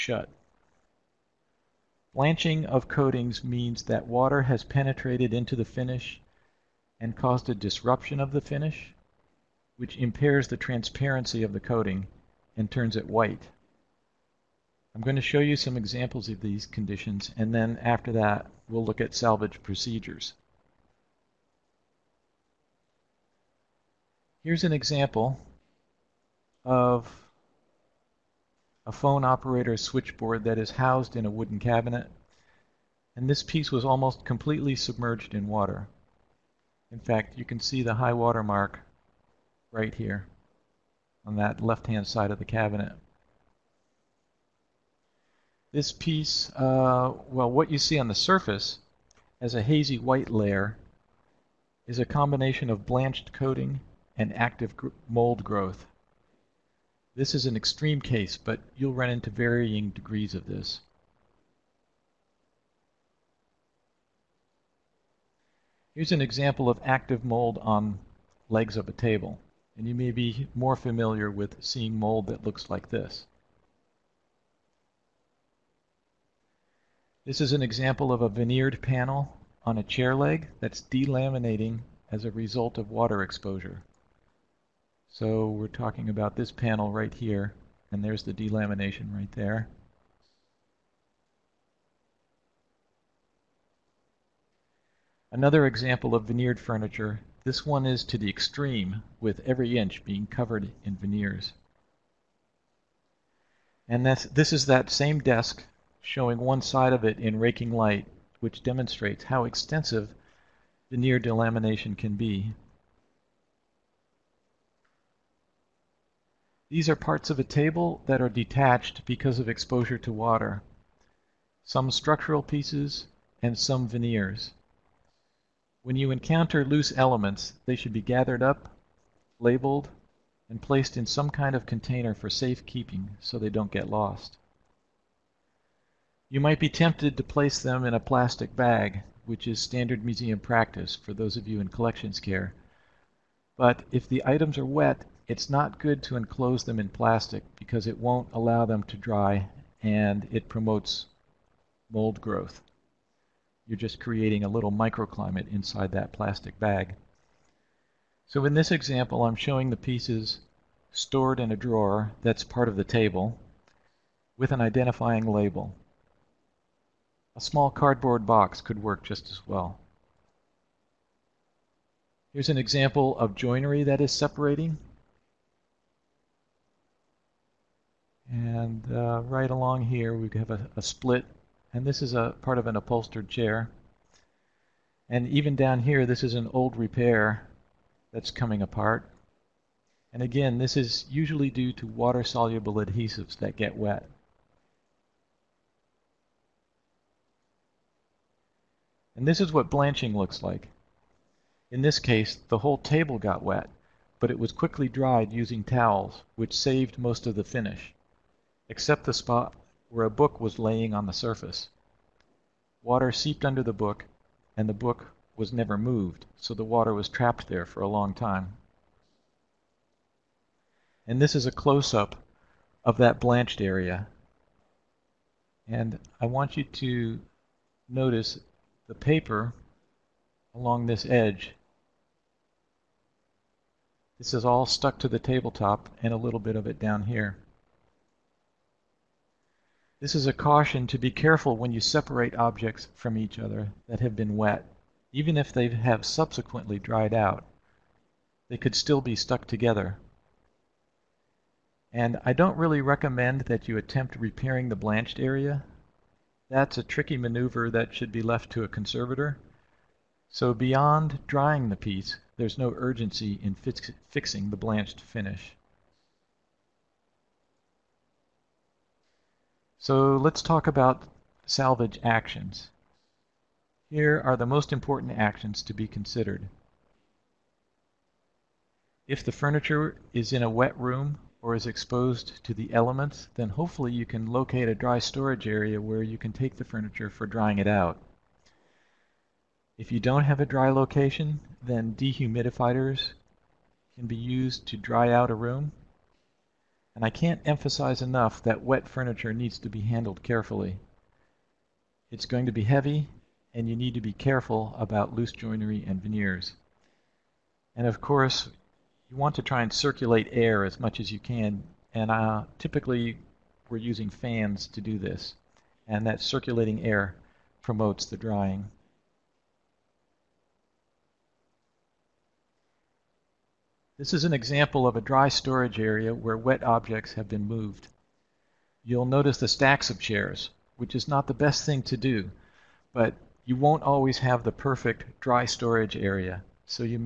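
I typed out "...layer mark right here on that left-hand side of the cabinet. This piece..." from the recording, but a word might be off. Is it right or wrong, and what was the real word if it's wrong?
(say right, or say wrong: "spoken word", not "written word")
wrong: "water", not "layer".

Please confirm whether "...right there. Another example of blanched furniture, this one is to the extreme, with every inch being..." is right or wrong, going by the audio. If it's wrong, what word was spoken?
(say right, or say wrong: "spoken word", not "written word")
wrong: "veneered", not "blanched".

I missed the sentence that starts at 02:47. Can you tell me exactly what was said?
A small cardboard box could work just as well.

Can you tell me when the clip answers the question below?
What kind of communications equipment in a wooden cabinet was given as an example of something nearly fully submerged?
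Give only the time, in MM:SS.
00:28.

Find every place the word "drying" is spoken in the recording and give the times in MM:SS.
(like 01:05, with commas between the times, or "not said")
04:21, 04:47, 05:18.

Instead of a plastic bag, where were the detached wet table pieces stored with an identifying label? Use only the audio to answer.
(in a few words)
a drawer.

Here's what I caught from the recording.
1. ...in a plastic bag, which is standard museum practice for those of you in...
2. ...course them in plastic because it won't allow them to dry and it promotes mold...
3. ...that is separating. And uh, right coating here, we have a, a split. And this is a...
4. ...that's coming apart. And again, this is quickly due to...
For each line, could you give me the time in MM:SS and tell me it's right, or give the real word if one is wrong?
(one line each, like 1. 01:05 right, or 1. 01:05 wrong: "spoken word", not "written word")
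1. 02:17 right
2. 02:26 wrong: "enclose", not "course"
3. 02:53 wrong: "along", not "coating"
4. 03:08 wrong: "usually", not "quickly".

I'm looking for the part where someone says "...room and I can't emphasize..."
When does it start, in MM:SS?
04:55.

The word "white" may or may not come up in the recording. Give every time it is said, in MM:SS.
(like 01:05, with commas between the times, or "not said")
00:13, 00:49.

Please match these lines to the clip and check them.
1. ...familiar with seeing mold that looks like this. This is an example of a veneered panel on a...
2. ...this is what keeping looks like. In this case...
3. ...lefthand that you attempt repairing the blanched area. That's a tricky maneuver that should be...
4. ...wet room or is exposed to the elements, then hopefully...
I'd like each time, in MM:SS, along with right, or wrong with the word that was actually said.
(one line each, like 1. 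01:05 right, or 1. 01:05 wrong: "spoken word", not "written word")
1. 01:10 right
2. 03:19 wrong: "blanching", not "keeping"
3. 04:12 wrong: "recommend", not "lefthand"
4. 04:40 right.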